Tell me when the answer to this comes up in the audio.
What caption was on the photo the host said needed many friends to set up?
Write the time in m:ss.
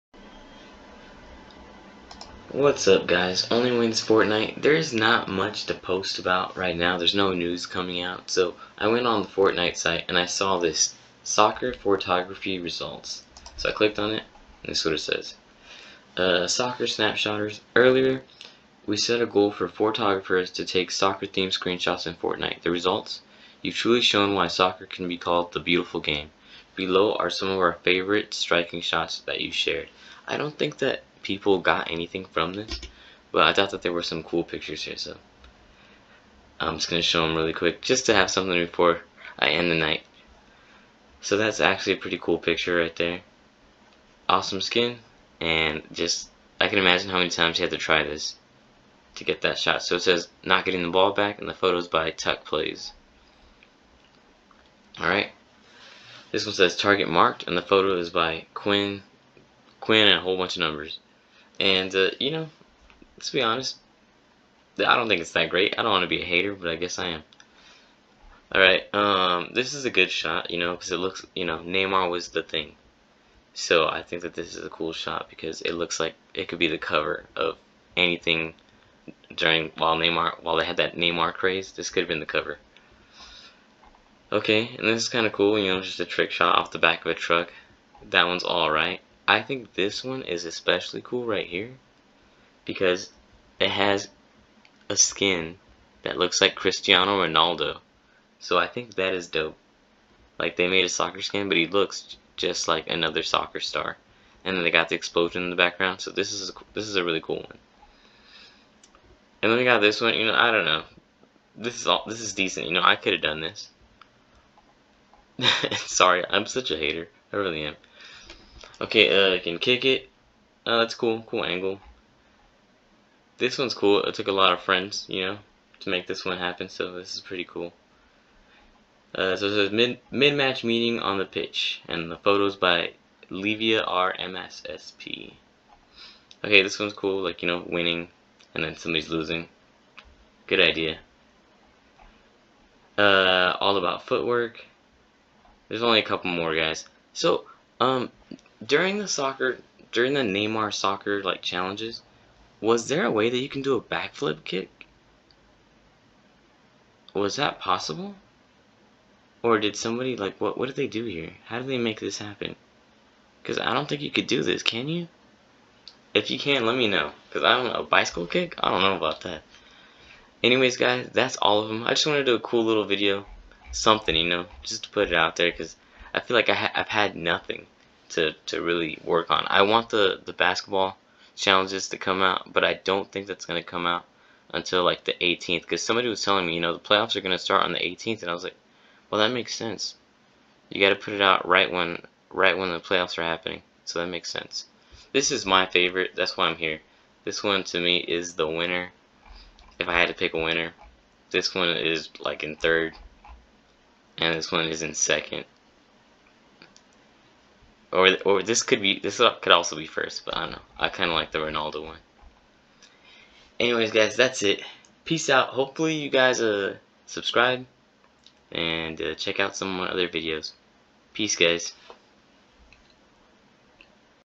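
2:10.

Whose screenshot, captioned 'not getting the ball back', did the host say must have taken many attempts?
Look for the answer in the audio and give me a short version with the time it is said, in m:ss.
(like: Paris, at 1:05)
Tuck Plays, at 0:52.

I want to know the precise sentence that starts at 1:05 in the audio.
I don't want to be a hater, but I guess I am.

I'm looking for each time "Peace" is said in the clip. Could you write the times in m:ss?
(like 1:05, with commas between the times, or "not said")
3:35, 3:41.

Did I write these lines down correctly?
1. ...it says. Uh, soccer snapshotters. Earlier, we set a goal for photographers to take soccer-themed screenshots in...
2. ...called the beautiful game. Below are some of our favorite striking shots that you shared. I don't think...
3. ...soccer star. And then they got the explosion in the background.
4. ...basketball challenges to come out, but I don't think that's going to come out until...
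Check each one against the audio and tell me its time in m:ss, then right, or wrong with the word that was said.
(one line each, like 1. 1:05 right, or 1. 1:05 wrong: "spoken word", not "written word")
1. 0:14 right
2. 0:25 right
3. 1:43 right
4. 3:00 right.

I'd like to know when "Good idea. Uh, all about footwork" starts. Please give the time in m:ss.
2:20.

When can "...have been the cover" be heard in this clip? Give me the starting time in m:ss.
1:22.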